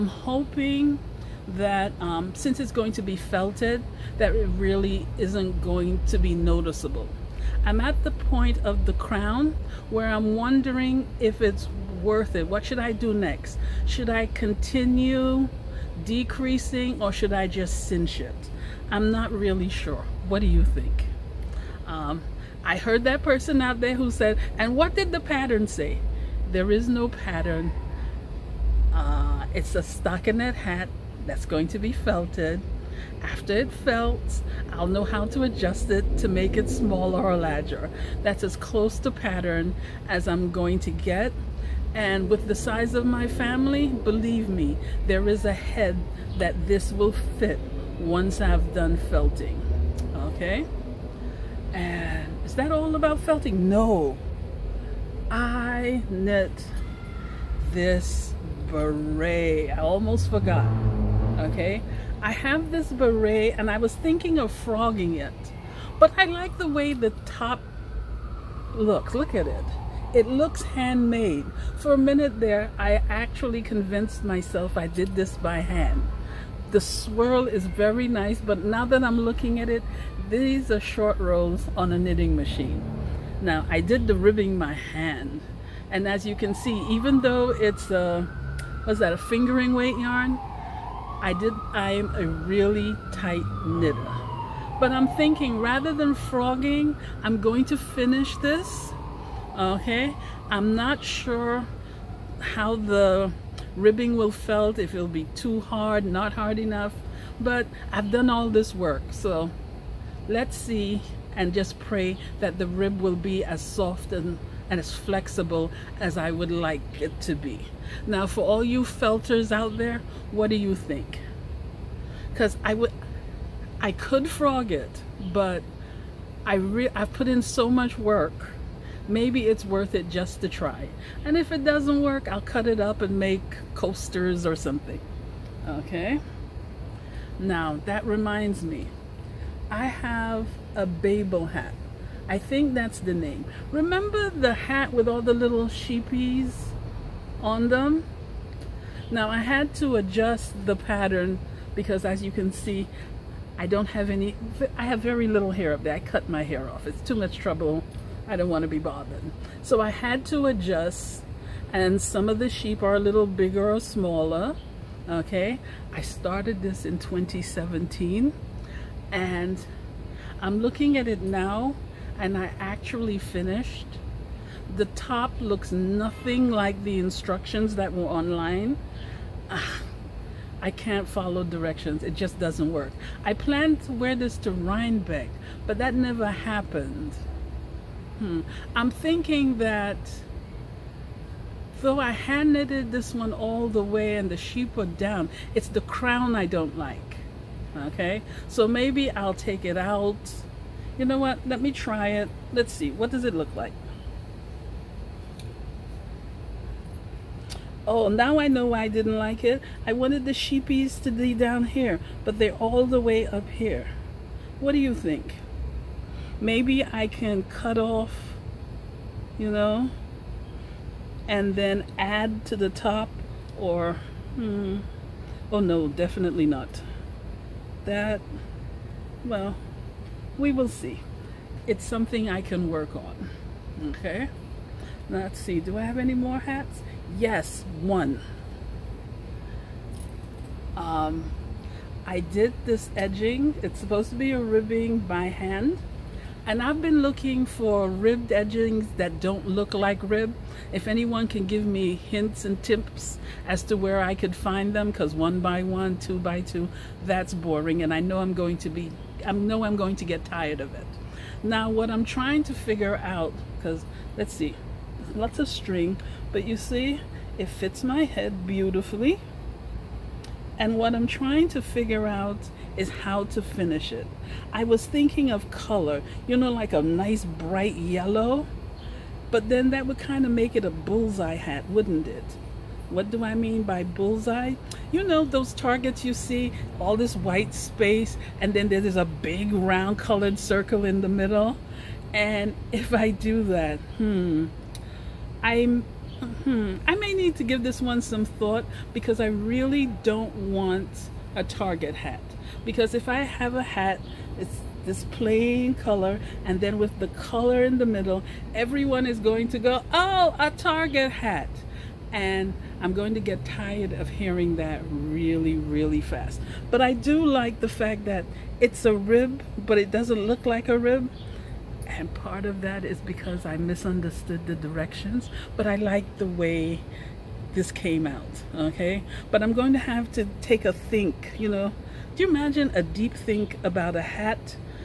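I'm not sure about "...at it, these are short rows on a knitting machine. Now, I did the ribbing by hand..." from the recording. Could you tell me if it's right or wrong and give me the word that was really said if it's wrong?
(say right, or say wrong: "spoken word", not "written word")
right.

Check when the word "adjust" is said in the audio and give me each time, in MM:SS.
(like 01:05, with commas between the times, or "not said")
00:35, 02:29, 02:40.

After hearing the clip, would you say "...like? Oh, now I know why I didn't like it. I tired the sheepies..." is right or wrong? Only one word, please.
wrong.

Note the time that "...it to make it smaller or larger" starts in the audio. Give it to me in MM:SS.
00:35.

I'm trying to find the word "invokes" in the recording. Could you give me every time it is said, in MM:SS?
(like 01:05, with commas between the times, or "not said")
not said.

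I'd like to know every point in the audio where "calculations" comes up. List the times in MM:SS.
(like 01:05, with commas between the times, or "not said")
not said.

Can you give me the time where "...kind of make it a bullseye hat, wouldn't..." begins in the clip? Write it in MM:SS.
04:39.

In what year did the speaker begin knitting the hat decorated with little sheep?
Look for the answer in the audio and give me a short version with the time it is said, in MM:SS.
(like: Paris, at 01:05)
2017, at 02:46.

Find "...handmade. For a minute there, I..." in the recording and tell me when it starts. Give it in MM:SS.
01:10.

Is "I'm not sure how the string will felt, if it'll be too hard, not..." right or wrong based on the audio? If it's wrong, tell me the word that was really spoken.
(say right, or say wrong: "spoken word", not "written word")
wrong: "ribbing", not "string".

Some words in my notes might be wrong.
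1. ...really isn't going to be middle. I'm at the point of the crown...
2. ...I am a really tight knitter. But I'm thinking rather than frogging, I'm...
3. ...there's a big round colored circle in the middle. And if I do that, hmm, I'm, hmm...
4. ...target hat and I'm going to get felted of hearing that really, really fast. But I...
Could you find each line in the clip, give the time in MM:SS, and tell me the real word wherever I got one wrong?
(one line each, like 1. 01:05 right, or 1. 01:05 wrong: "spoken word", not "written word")
1. 00:04 wrong: "noticeable", not "middle"
2. 01:31 right
3. 04:48 right
4. 05:10 wrong: "tired", not "felted".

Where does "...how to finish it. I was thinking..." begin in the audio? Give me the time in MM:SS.
04:32.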